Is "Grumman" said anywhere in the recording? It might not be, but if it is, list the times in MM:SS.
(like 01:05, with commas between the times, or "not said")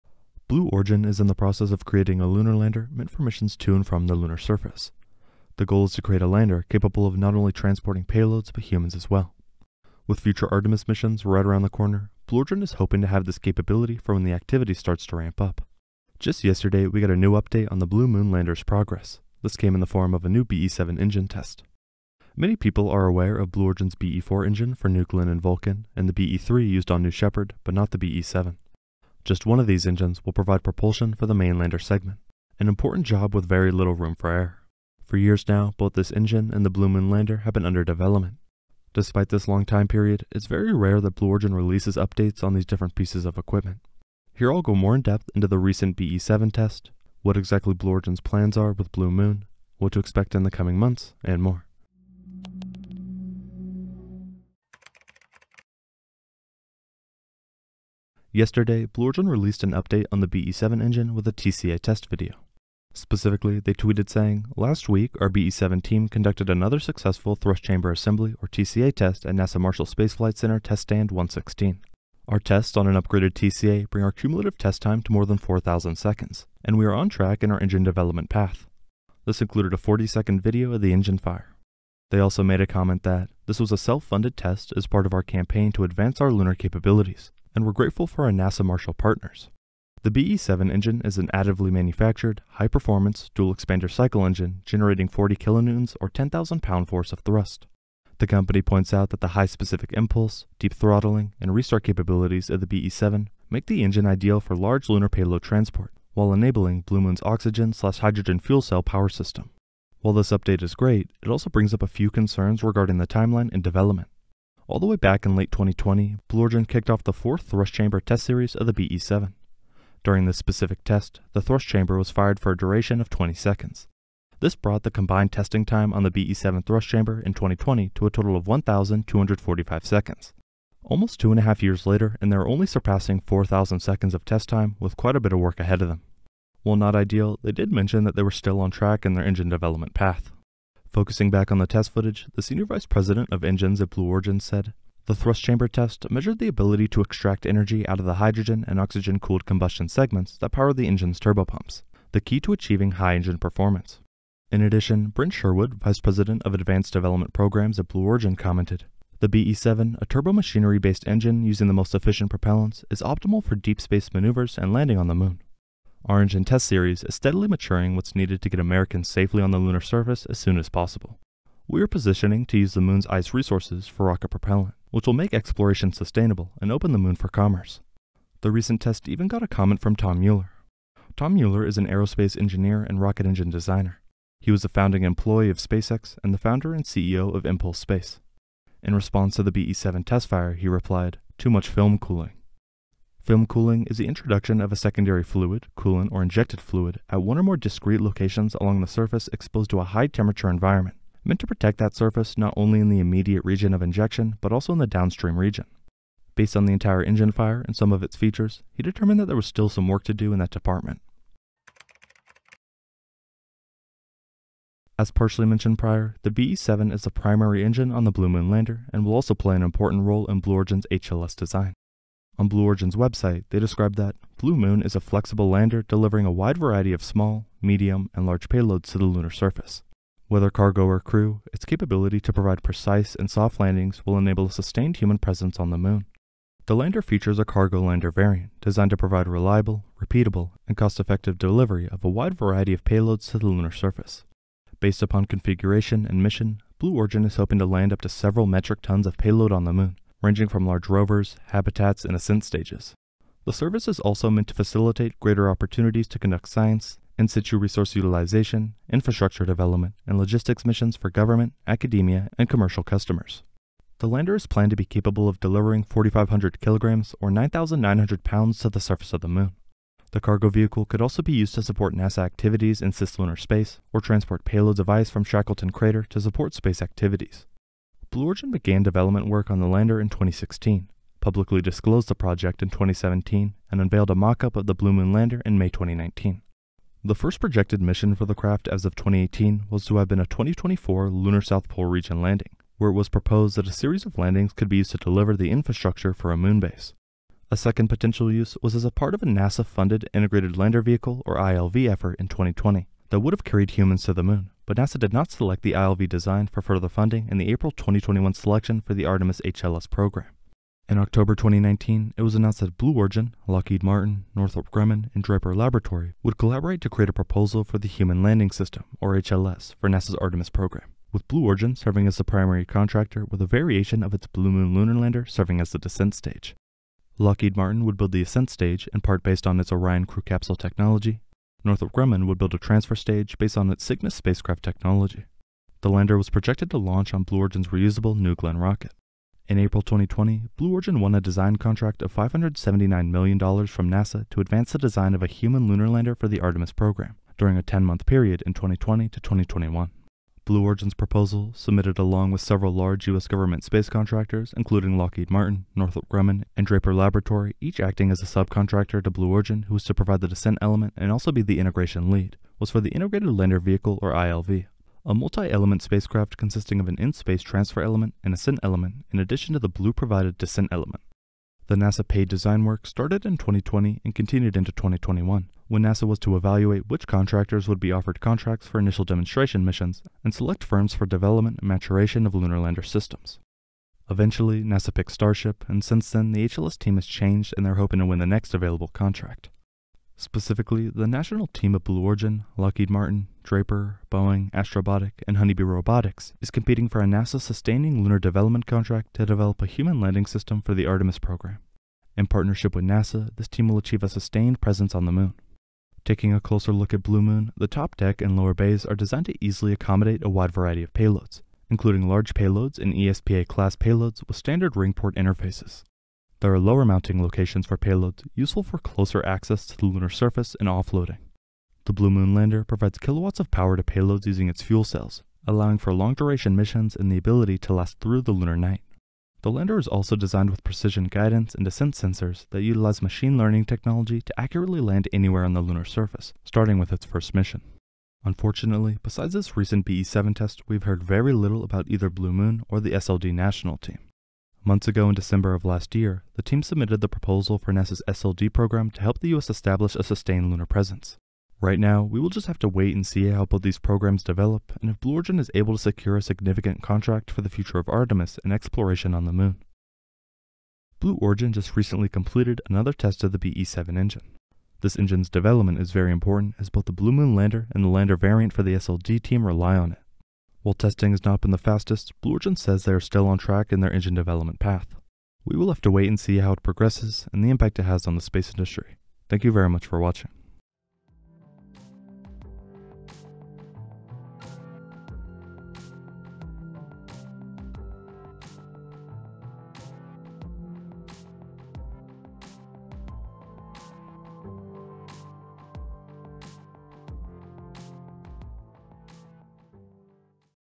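05:14, 05:31, 05:56.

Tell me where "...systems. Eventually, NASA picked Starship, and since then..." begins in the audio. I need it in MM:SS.
06:22.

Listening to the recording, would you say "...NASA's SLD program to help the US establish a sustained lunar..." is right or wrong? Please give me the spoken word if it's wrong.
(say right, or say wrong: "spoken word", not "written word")
right.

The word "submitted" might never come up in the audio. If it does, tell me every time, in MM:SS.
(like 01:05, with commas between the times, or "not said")
05:51, 07:26.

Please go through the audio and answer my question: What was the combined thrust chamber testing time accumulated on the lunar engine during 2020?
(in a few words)
1,245 seconds.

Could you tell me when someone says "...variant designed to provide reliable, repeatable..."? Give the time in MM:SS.
03:58.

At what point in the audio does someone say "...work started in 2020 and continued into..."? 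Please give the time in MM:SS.
06:12.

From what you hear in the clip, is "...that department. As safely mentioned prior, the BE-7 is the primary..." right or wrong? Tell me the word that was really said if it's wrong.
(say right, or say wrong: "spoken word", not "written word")
wrong: "partially", not "safely".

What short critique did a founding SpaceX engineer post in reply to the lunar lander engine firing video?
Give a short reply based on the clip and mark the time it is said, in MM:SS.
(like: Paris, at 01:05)
Too much film cooling, at 03:11.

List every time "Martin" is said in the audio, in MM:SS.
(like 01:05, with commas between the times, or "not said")
05:13, 05:27, 05:55, 06:32.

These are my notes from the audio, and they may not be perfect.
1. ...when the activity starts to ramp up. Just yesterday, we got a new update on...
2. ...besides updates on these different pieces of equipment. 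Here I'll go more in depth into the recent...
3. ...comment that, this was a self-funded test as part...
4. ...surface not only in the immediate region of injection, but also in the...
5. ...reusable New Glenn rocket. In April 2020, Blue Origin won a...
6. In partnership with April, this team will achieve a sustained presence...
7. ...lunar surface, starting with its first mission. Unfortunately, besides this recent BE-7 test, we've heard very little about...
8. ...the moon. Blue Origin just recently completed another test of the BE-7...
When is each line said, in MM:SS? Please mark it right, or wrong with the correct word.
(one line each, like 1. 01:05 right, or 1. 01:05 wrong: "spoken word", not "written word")
1. 00:14 right
2. 00:41 wrong: "releases", not "besides"
3. 01:22 right
4. 03:21 right
5. 05:37 right
6. 06:42 wrong: "NASA", not "April"
7. 07:15 right
8. 07:39 right.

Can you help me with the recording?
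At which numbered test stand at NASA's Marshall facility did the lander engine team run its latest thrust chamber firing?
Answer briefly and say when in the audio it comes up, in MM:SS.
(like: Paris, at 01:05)
116, at 01:10.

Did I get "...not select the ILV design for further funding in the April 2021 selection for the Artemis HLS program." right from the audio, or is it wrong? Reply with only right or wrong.
right.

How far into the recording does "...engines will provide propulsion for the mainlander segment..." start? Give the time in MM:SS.
00:29.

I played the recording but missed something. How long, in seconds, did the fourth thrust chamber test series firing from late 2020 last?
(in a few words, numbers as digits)
20 seconds.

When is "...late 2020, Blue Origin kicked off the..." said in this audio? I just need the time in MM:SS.
01:55.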